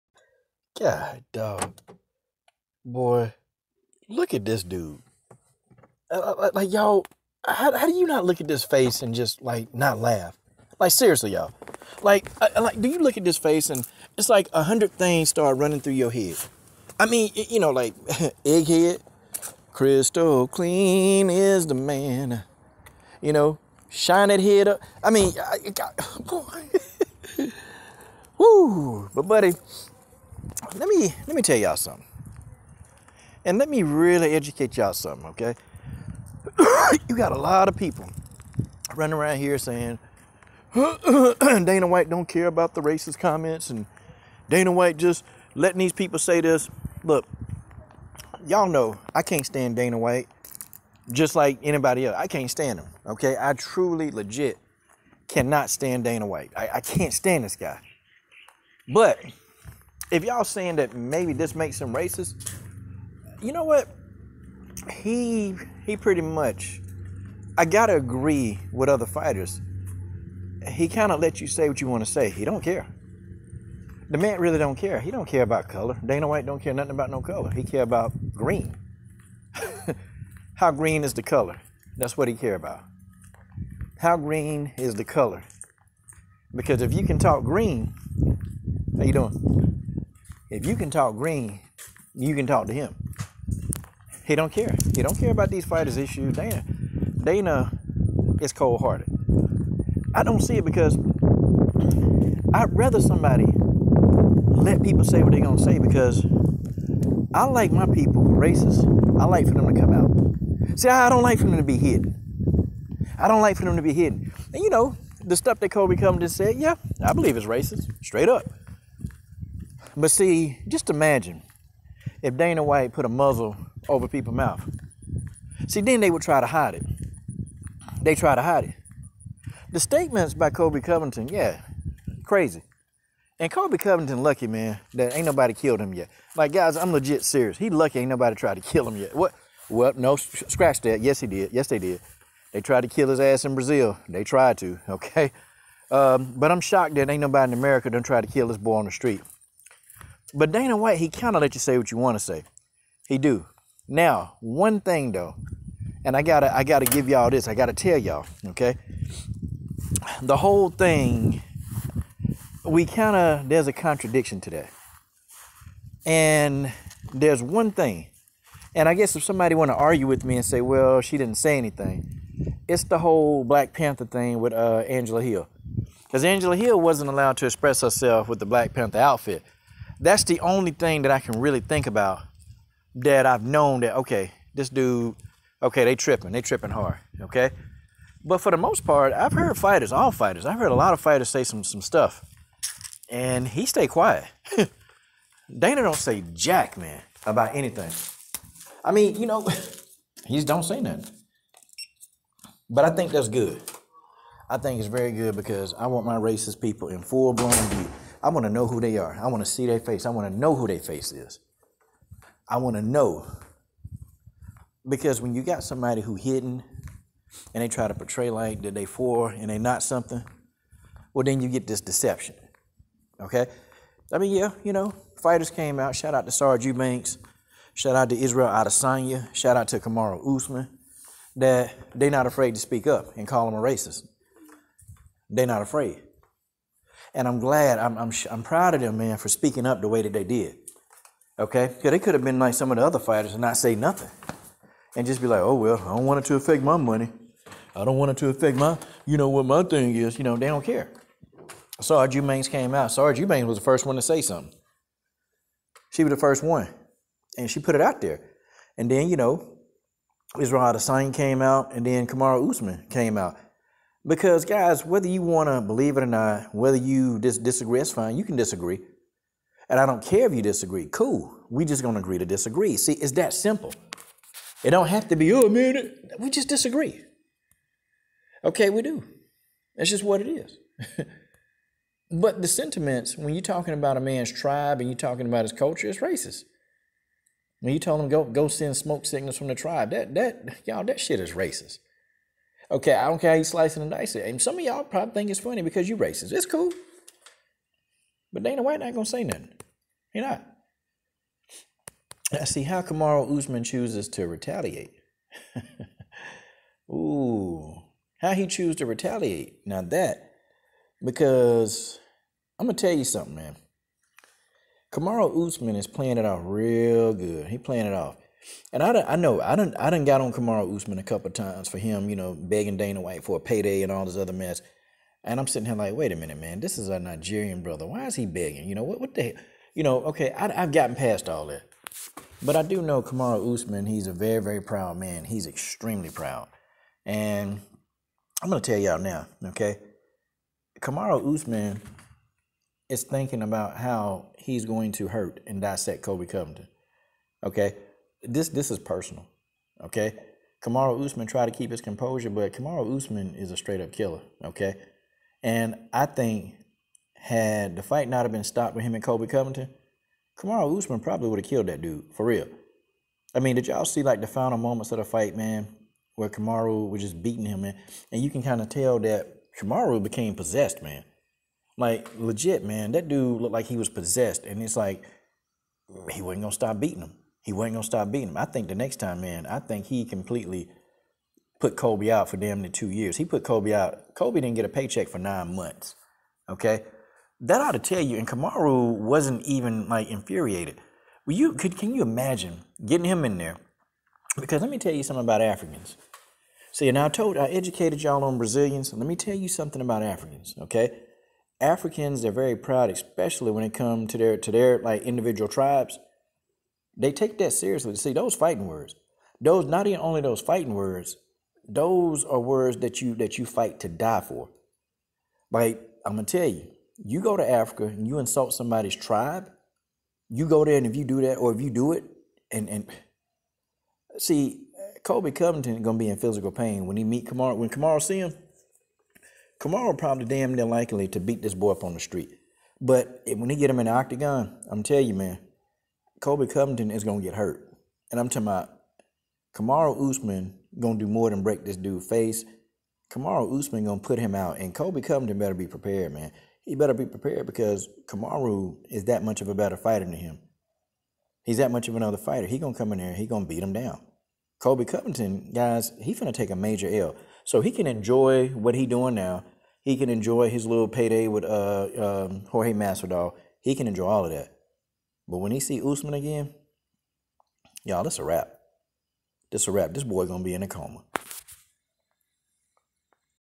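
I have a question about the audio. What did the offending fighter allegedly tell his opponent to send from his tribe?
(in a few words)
Smoke signals.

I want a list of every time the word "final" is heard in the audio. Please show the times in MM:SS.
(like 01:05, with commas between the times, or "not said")
06:04.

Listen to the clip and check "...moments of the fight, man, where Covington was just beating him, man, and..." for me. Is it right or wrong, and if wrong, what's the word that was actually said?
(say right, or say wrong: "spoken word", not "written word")
wrong: "Kamaru", not "Covington".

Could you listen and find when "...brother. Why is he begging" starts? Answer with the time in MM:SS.
05:27.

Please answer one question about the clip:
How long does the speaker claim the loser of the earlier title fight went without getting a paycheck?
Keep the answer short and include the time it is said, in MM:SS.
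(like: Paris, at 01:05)
9 months, at 06:25.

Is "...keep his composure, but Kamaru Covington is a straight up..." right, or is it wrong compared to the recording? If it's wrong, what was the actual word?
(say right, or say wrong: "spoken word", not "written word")
wrong: "Usman", not "Covington".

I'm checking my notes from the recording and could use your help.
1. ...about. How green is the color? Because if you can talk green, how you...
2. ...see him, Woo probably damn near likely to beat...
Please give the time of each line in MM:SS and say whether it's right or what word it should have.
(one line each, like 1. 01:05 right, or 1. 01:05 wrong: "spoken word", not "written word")
1. 01:22 right
2. 07:08 wrong: "Kamaru", not "Woo".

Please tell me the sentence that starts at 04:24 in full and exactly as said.
Because, guys, whether you want to believe it or not, whether you dis- disagree, that's fine.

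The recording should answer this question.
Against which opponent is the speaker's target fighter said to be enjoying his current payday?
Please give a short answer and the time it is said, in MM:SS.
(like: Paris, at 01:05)
Jorge Masvidal, at 07:42.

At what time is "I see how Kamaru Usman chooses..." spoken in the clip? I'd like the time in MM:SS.
05:02.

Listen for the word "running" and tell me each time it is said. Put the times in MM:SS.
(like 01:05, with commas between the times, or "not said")
00:15, 00:38.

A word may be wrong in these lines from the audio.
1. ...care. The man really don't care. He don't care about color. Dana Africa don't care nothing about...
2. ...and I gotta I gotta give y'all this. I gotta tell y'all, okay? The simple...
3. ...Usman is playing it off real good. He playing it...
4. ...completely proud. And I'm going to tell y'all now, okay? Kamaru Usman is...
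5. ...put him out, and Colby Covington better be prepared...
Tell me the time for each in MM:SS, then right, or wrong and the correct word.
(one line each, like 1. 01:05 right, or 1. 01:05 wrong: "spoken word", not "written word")
1. 01:12 wrong: "White", not "Africa"
2. 02:36 wrong: "whole", not "simple"
3. 05:15 right
4. 05:35 wrong: "extremely", not "completely"
5. 07:23 right.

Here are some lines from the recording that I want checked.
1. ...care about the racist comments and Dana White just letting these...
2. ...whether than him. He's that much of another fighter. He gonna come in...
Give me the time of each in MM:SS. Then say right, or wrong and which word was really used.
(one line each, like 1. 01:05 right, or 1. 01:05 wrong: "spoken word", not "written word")
1. 00:42 right
2. 07:29 wrong: "fighter", not "whether".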